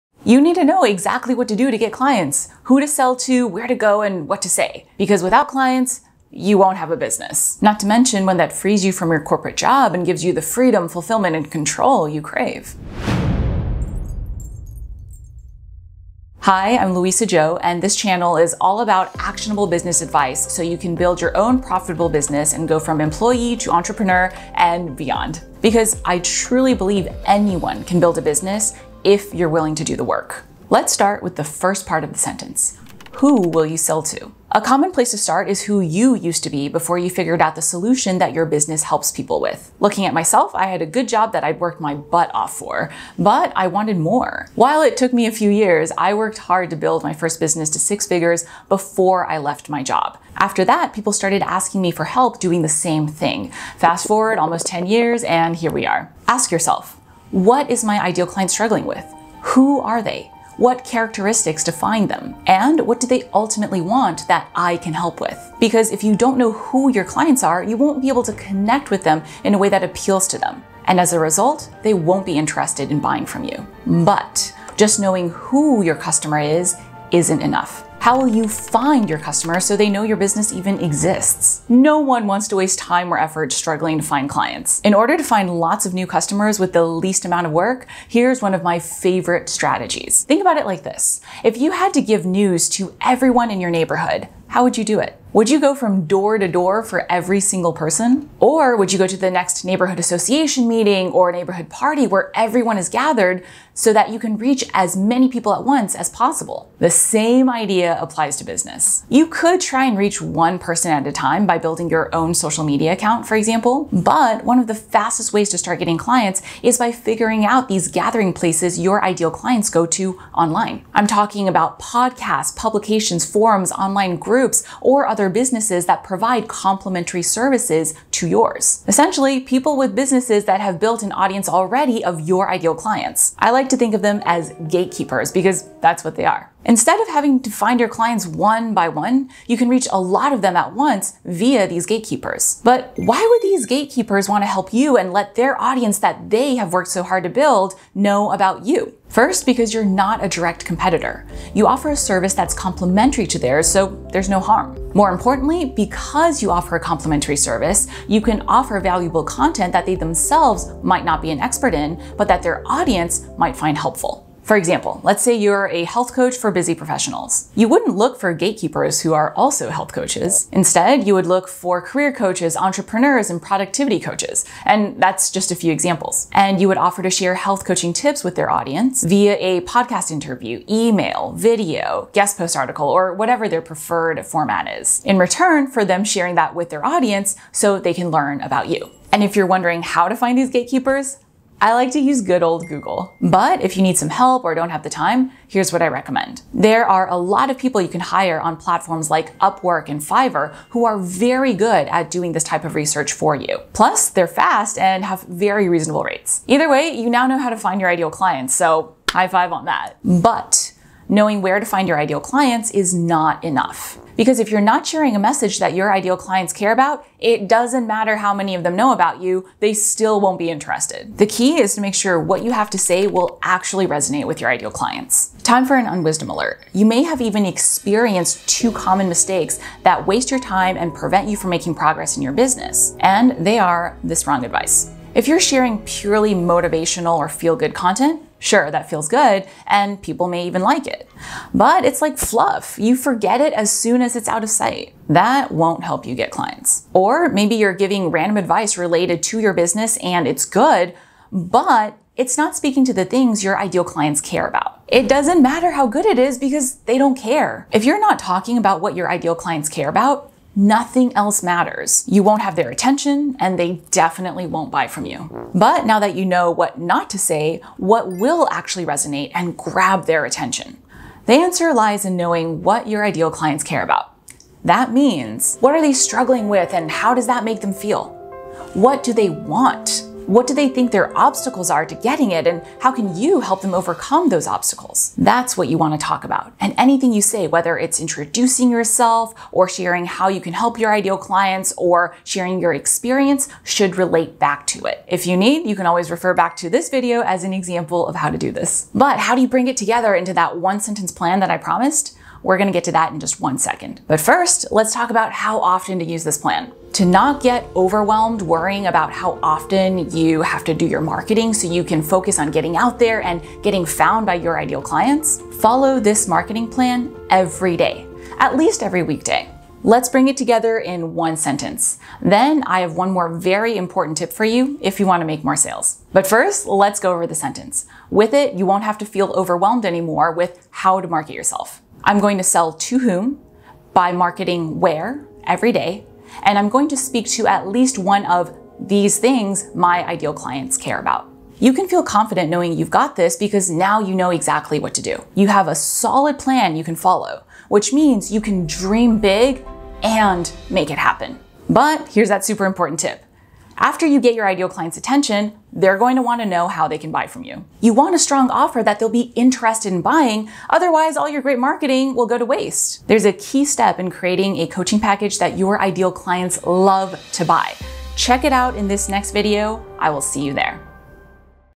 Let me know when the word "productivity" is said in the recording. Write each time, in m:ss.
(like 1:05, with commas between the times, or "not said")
2:53.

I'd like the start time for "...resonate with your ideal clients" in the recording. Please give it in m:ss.
3:43.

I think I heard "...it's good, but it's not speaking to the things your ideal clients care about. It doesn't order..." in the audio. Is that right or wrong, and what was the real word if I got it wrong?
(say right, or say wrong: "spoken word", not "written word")
wrong: "matter", not "order".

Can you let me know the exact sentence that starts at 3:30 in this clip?
But knowing where to find your ideal clients is not enough.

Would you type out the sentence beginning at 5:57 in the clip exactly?
You want a strong offer that they'll be interested in buying.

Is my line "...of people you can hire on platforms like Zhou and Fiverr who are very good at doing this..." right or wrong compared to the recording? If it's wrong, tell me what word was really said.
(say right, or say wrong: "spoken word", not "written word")
wrong: "Upwork", not "Zhou".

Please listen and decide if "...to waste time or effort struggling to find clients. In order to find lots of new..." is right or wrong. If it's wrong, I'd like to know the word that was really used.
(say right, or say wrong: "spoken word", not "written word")
right.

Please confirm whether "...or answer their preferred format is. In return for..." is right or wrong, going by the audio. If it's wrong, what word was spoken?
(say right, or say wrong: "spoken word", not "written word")
wrong: "whatever", not "answer".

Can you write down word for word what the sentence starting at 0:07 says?
Not to mention when that frees you from your corporate job and gives you the freedom, fulfillment, and control you crave.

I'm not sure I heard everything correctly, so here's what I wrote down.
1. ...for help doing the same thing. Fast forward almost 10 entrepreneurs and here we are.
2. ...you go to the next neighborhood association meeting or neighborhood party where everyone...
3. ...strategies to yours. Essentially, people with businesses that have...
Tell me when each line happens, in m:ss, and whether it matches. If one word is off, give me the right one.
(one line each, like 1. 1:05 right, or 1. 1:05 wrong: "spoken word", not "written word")
1. 0:51 wrong: "years", not "entrepreneurs"
2. 1:38 right
3. 2:07 wrong: "services", not "strategies".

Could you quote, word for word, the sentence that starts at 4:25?
But now that you know what not to say, what will actually resonate and grab their attention?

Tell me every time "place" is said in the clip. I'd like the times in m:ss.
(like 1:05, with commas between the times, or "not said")
0:34, 1:58.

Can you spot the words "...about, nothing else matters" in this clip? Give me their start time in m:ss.
4:19.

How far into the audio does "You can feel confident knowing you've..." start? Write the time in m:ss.
5:41.